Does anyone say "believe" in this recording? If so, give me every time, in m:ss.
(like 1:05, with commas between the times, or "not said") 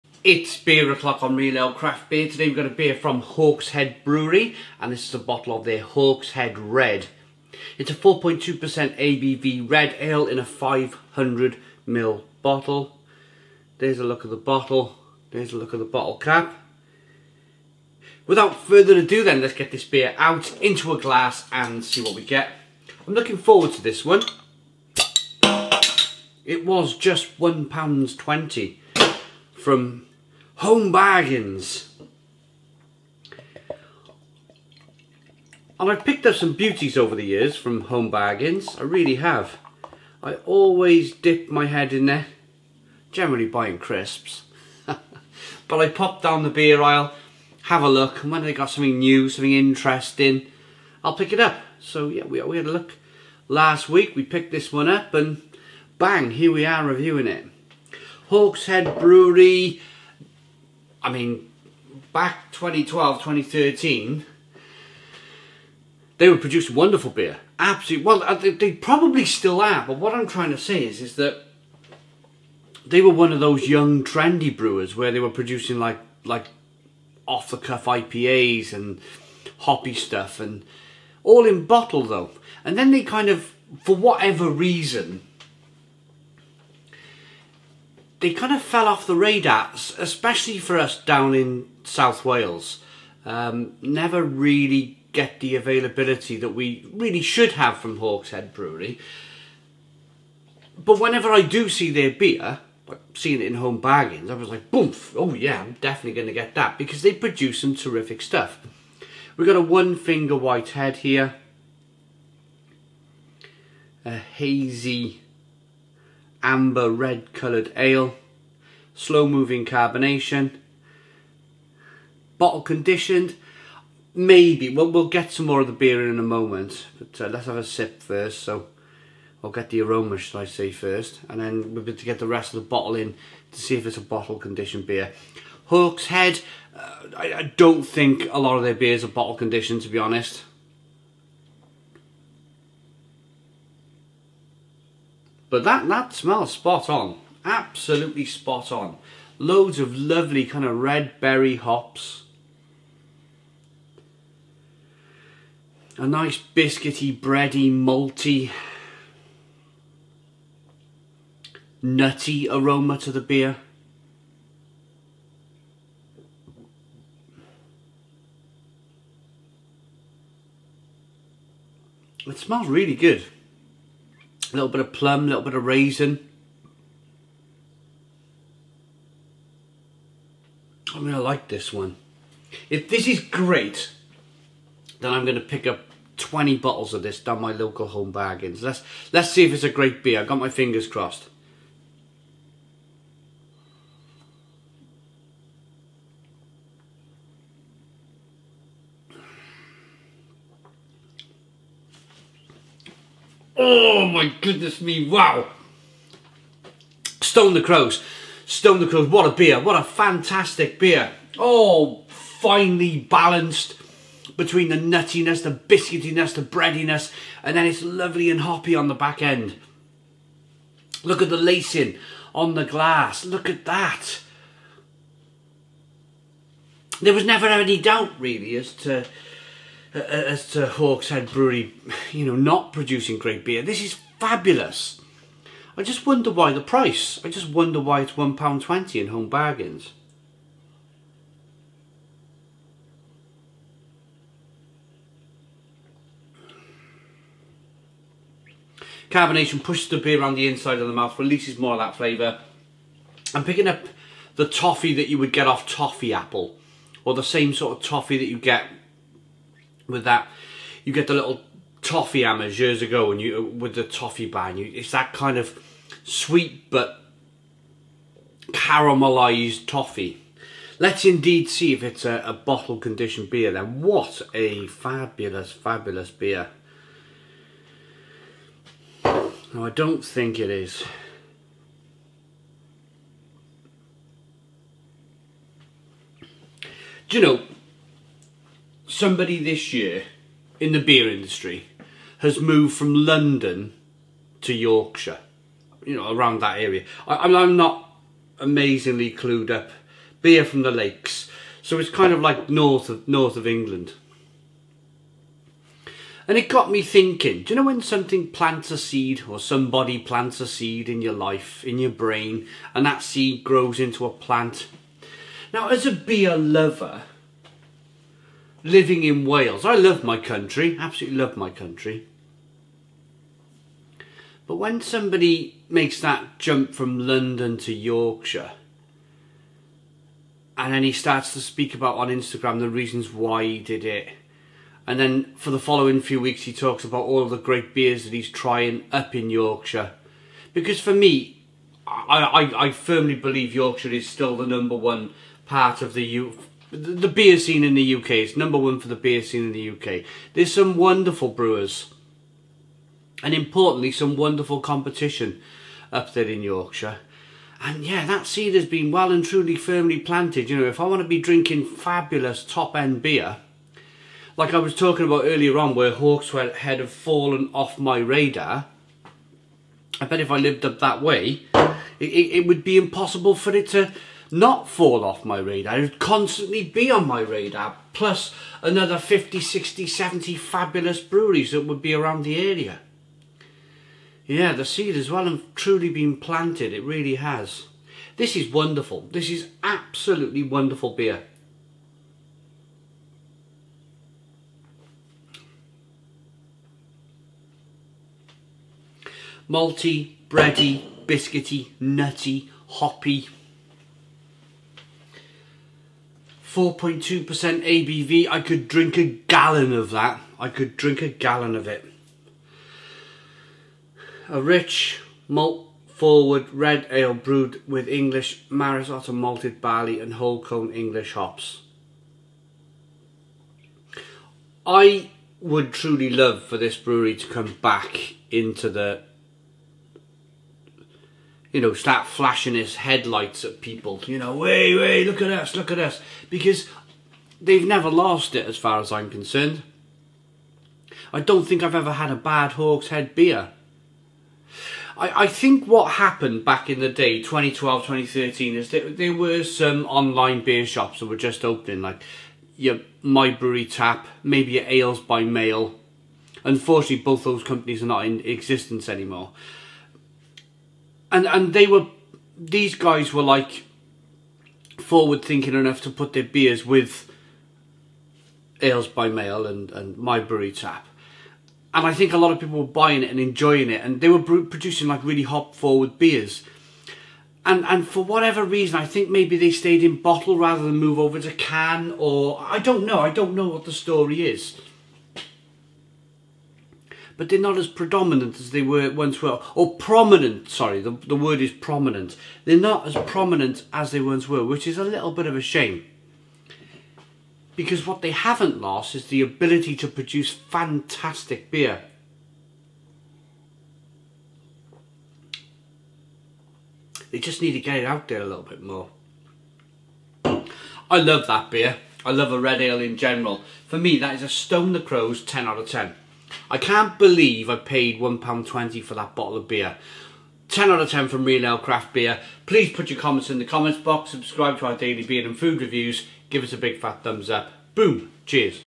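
5:43, 8:36.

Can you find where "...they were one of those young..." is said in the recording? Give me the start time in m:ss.
1:12.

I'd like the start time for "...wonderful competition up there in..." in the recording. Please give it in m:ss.
5:54.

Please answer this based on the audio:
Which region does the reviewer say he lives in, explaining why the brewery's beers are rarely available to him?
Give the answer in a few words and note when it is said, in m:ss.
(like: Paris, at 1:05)
South Wales, at 1:31.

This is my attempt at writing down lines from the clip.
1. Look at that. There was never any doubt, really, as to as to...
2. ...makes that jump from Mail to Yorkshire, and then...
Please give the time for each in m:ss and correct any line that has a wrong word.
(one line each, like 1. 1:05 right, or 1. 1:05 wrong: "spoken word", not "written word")
1. 3:43 right
2. 5:25 wrong: "London", not "Mail".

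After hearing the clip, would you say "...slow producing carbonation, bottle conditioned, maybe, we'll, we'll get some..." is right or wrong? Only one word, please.
wrong.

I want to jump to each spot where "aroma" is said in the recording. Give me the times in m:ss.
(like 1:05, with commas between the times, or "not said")
2:09, 2:42.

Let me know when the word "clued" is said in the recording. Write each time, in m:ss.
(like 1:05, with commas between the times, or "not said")
4:59.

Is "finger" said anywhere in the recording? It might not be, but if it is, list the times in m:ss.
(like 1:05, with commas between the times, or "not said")
1:49, 3:10.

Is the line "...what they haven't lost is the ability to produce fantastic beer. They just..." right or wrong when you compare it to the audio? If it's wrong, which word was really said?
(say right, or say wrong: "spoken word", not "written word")
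right.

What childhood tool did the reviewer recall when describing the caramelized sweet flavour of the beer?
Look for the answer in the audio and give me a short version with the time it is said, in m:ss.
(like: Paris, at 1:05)
Toffee hammers, at 4:21.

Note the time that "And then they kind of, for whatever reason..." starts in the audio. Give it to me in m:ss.
1:22.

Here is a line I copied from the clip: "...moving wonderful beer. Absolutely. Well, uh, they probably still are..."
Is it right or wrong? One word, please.
wrong.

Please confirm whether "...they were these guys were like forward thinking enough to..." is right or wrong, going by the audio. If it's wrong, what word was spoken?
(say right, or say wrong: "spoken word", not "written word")
right.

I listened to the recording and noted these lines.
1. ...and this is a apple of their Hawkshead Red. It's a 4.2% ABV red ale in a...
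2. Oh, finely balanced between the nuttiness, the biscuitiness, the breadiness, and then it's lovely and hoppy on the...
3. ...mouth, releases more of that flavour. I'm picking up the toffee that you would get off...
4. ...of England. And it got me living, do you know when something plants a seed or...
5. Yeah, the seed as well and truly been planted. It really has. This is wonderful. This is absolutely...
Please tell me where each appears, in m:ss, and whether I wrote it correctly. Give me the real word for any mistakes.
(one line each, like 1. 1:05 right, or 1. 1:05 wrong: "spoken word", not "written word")
1. 0:04 wrong: "bottle", not "apple"
2. 3:31 right
3. 4:10 right
4. 5:03 wrong: "thinking", not "living"
5. 6:24 right.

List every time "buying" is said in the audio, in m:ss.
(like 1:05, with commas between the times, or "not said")
0:43, 7:52.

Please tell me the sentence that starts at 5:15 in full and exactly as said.
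Now, as a beer lover, living in Wales.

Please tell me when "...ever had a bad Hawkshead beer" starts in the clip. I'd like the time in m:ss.
7:21.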